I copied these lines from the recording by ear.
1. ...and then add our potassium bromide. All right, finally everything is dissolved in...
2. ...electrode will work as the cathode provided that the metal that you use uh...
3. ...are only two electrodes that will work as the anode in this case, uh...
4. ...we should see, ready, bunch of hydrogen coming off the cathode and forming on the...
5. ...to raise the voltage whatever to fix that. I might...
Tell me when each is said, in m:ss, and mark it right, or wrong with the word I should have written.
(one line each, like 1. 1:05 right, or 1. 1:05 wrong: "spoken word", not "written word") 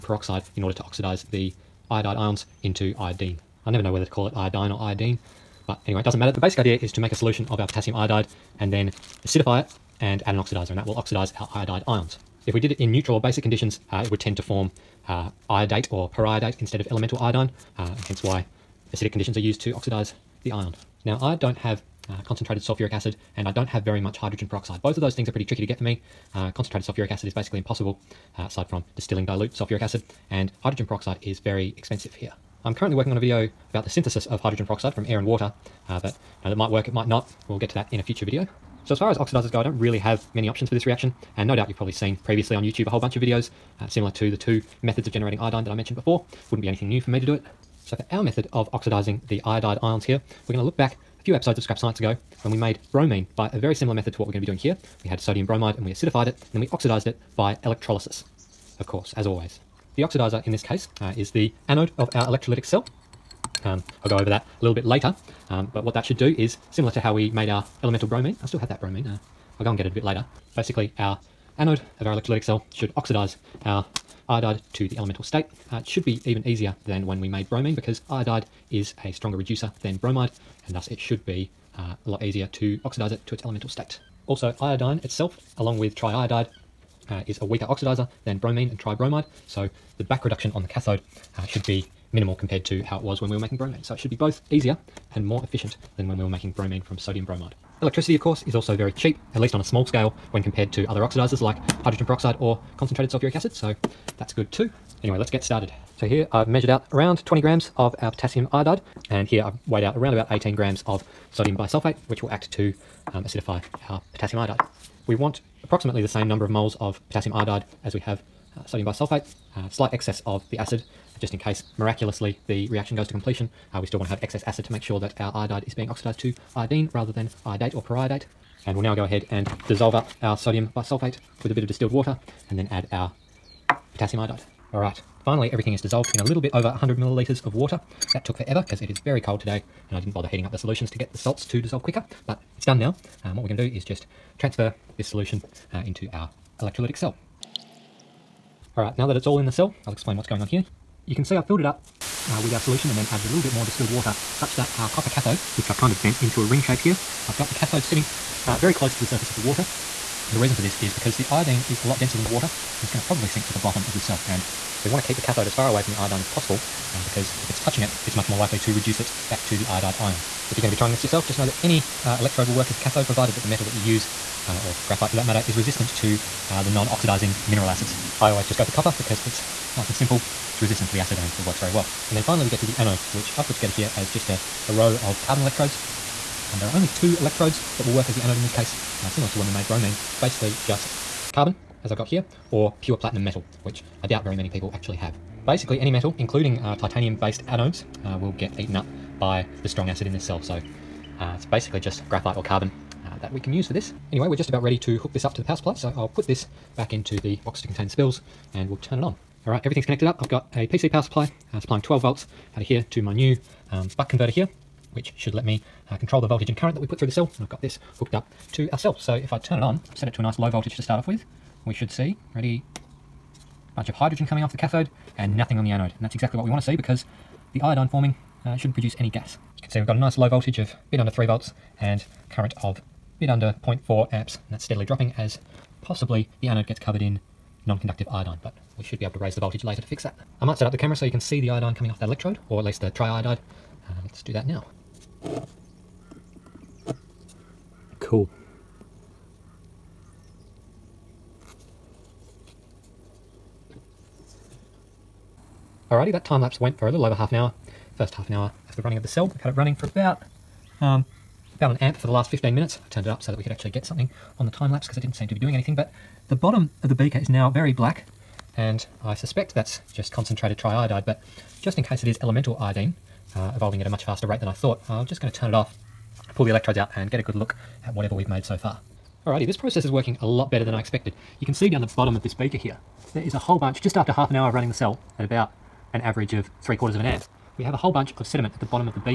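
1. 2:12 wrong: "iodide", not "bromide"
2. 2:52 right
3. 3:06 right
4. 3:41 wrong: "nothing", not "forming"
5. 3:59 wrong: "later", not "whatever".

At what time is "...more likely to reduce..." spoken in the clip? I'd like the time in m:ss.
2:48.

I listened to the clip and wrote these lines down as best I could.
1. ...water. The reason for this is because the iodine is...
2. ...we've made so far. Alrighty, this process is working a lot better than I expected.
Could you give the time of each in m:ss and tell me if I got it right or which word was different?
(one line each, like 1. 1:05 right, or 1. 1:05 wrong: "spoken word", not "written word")
1. 2:39 right
2. 4:38 right.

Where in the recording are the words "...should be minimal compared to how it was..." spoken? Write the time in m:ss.
1:31.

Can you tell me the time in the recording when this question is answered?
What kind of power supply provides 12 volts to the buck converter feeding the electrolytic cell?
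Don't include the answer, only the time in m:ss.
3:30.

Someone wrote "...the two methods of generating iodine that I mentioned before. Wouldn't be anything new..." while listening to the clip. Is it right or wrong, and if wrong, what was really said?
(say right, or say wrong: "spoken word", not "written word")
right.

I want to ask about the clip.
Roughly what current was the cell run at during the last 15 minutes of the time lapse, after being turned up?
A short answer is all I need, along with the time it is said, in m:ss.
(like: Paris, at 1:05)
about 1 amp, at 4:21.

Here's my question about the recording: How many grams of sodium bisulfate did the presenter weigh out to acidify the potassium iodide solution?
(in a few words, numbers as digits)
18 grams.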